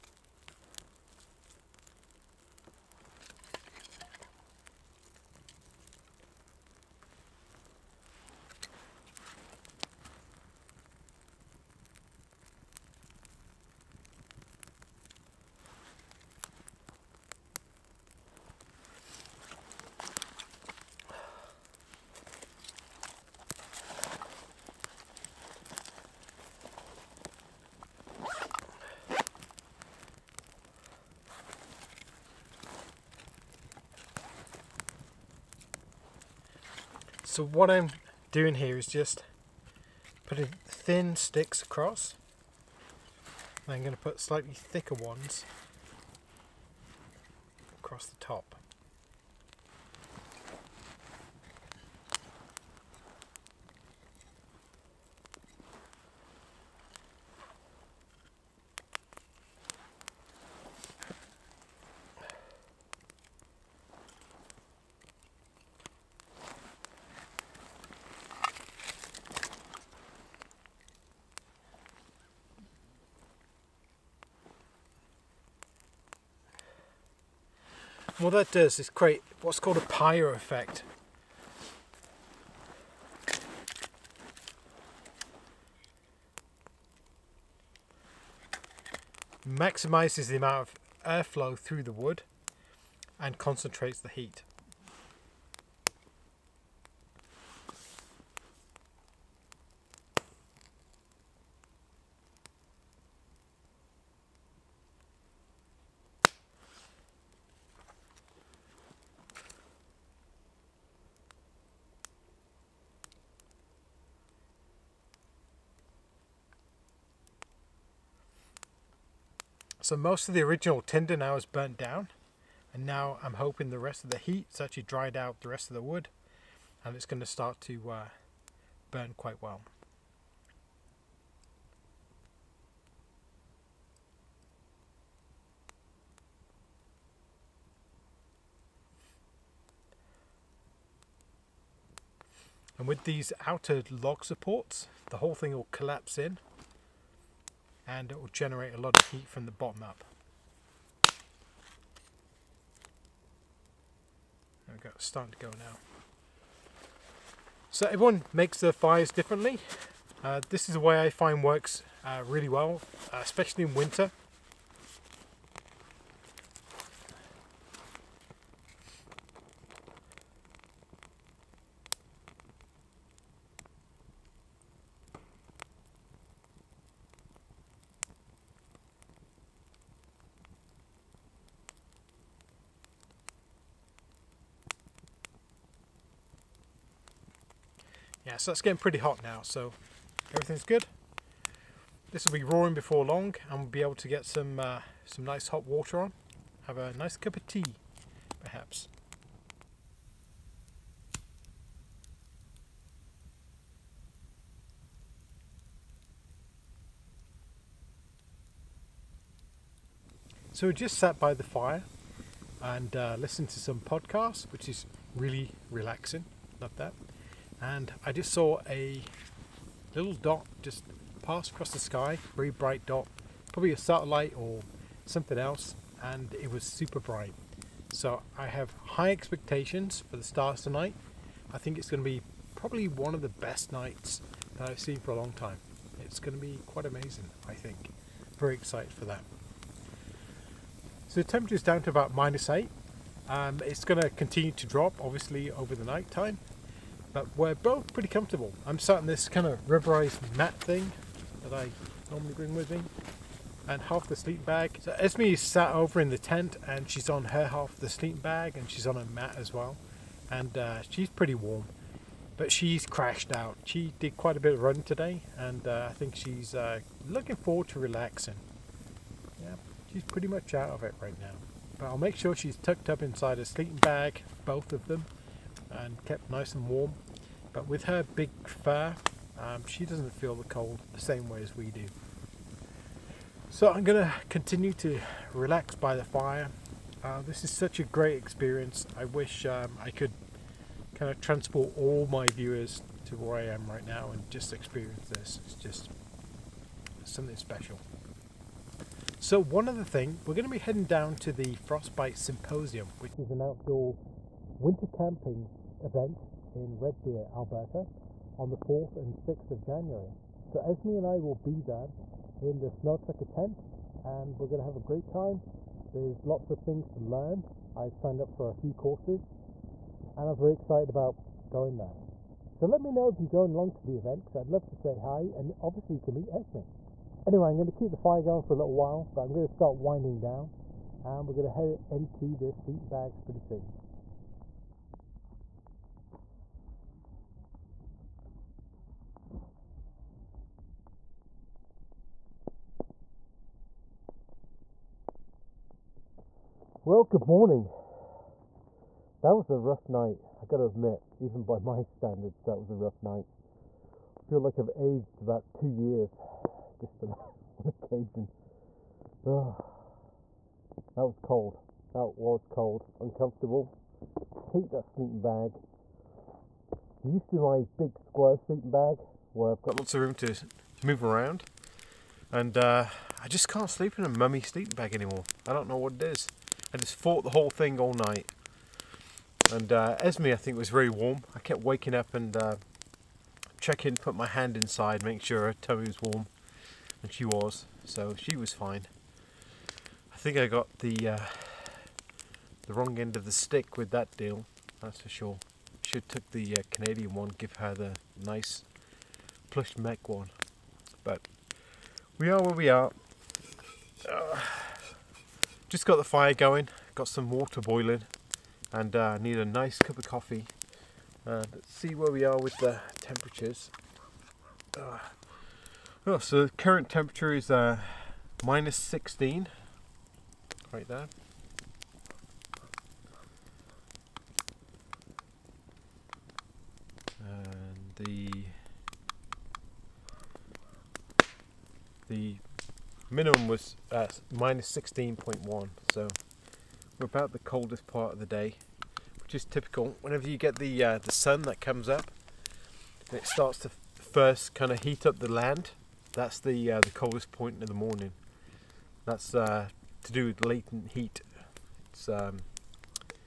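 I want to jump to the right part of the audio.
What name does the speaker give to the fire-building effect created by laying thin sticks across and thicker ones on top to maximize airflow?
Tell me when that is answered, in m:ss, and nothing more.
1:19.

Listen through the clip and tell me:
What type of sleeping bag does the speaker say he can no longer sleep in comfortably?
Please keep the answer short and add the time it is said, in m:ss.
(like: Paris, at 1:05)
mummy sleeping bag, at 6:14.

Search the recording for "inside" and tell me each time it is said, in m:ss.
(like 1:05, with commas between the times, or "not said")
4:33, 6:24.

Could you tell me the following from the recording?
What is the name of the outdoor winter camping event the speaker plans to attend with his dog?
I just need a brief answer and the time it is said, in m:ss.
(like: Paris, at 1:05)
Frostbite Symposium, at 5:01.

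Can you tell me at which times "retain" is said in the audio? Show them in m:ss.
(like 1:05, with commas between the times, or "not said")
not said.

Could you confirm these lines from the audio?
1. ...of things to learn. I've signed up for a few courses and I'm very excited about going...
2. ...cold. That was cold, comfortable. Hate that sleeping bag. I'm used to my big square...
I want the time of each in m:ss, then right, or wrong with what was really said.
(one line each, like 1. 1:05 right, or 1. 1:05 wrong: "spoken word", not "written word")
1. 5:16 right
2. 6:01 wrong: "uncomfortable", not "comfortable".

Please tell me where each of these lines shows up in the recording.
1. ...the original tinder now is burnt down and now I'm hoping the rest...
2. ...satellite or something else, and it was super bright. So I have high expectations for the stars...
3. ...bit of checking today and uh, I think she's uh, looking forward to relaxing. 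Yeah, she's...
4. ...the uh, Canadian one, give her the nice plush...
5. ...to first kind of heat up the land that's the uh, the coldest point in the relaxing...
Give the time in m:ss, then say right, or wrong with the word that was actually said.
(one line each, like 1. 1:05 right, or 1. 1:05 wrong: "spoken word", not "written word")
1. 2:00 right
2. 3:43 right
3. 4:24 wrong: "running", not "checking"
4. 6:36 right
5. 7:23 wrong: "morning", not "relaxing".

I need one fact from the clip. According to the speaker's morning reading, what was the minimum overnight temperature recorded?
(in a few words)
-16.1.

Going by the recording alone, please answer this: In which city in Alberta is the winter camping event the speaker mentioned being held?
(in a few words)
Red Deer.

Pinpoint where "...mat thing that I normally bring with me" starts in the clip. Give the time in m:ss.
4:10.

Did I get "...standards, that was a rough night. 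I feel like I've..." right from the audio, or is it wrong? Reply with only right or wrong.
right.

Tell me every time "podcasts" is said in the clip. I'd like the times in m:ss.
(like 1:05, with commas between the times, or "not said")
3:33.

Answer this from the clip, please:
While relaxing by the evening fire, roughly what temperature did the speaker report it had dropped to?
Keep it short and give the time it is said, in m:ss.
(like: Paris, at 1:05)
-8, at 4:02.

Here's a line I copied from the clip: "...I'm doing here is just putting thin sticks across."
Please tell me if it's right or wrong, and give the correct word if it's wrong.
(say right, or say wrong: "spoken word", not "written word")
right.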